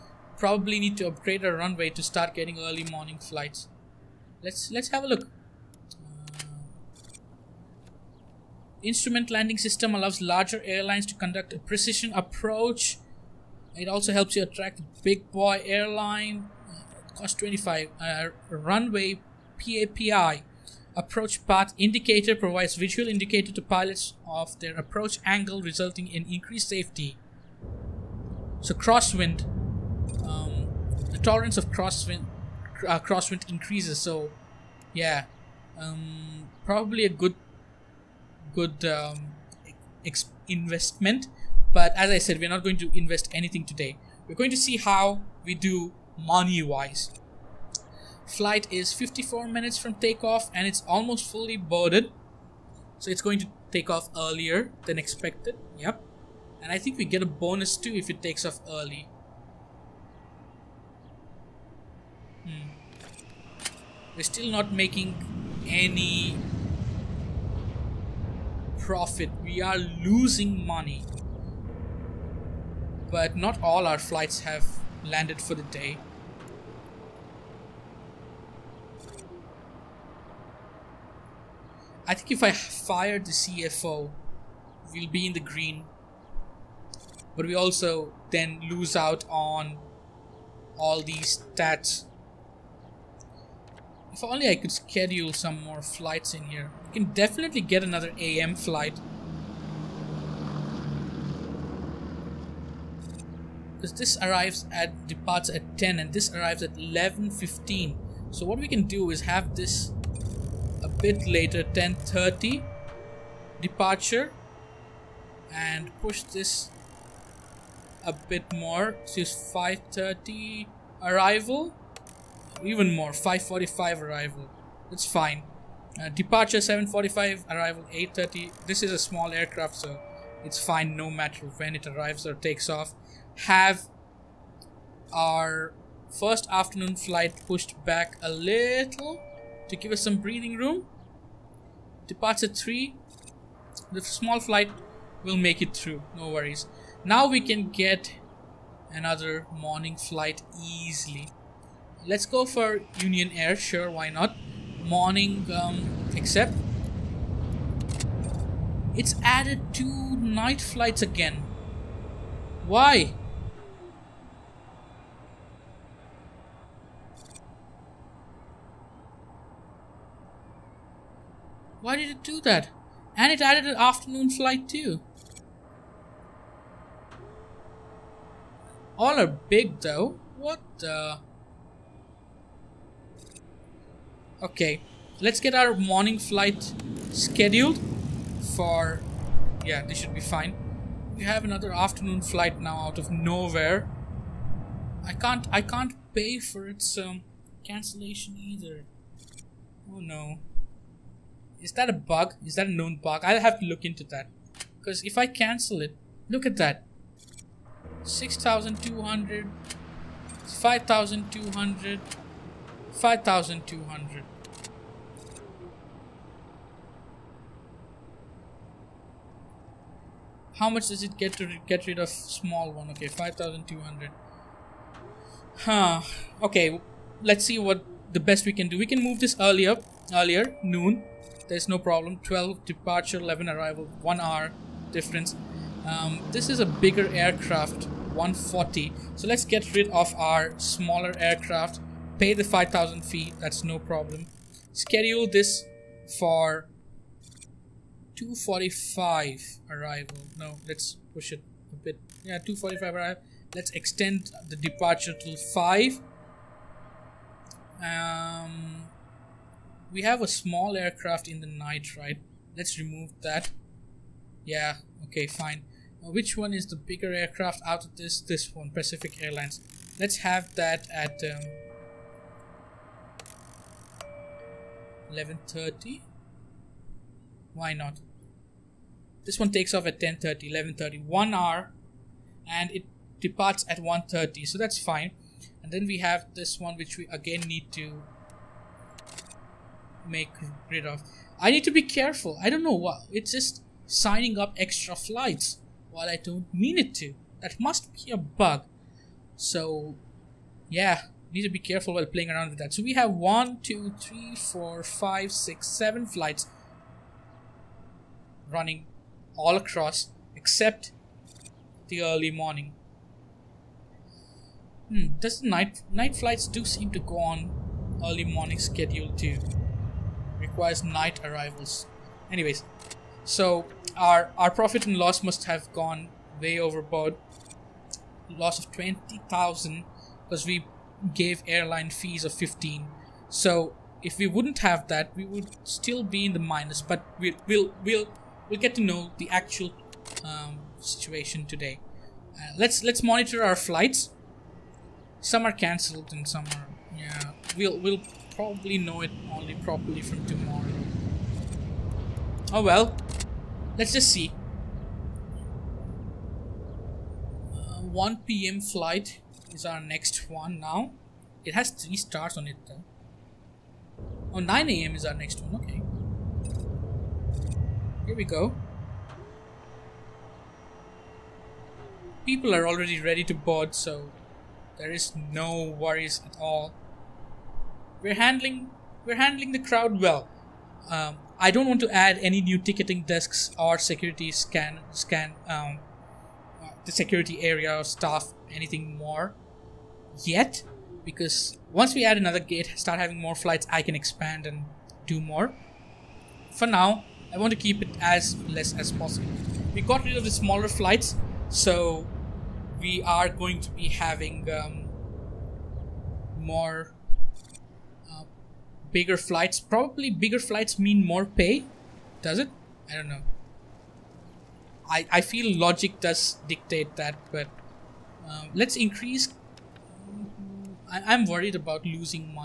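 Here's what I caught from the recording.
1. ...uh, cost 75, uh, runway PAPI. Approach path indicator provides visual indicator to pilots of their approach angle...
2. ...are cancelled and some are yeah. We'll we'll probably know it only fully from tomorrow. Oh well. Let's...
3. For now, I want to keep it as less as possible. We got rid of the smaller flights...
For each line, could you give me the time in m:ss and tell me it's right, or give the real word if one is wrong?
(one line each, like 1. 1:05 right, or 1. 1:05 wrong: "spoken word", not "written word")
1. 0:16 wrong: "25", not "75"
2. 5:45 wrong: "properly", not "fully"
3. 6:36 right.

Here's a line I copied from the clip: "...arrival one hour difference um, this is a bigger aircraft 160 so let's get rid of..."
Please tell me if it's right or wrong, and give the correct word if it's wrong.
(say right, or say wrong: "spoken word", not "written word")
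wrong: "140", not "160".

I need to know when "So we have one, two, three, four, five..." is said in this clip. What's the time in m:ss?
5:02.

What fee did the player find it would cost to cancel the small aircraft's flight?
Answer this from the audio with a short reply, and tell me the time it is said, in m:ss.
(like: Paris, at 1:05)
5,200, at 3:43.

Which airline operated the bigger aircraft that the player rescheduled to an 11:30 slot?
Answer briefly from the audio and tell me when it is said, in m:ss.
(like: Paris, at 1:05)
Pacific Airlines, at 4:28.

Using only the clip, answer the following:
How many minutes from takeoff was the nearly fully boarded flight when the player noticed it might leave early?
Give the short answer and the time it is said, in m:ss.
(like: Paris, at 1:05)
54, at 0:48.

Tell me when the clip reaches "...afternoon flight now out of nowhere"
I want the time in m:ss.
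3:11.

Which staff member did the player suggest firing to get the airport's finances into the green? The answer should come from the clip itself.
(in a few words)
CFO.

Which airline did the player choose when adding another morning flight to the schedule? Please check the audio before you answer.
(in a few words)
Union Air.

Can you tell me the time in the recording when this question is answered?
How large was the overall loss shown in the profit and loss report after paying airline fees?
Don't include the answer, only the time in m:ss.
5:28.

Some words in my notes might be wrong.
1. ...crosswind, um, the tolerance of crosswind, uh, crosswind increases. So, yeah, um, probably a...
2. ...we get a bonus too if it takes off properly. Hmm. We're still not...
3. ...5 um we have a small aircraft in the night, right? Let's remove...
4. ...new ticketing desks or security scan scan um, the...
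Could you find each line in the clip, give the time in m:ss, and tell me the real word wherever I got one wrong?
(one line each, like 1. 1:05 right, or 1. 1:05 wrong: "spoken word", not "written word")
1. 0:28 right
2. 0:56 wrong: "early", not "properly"
3. 4:15 right
4. 6:22 right.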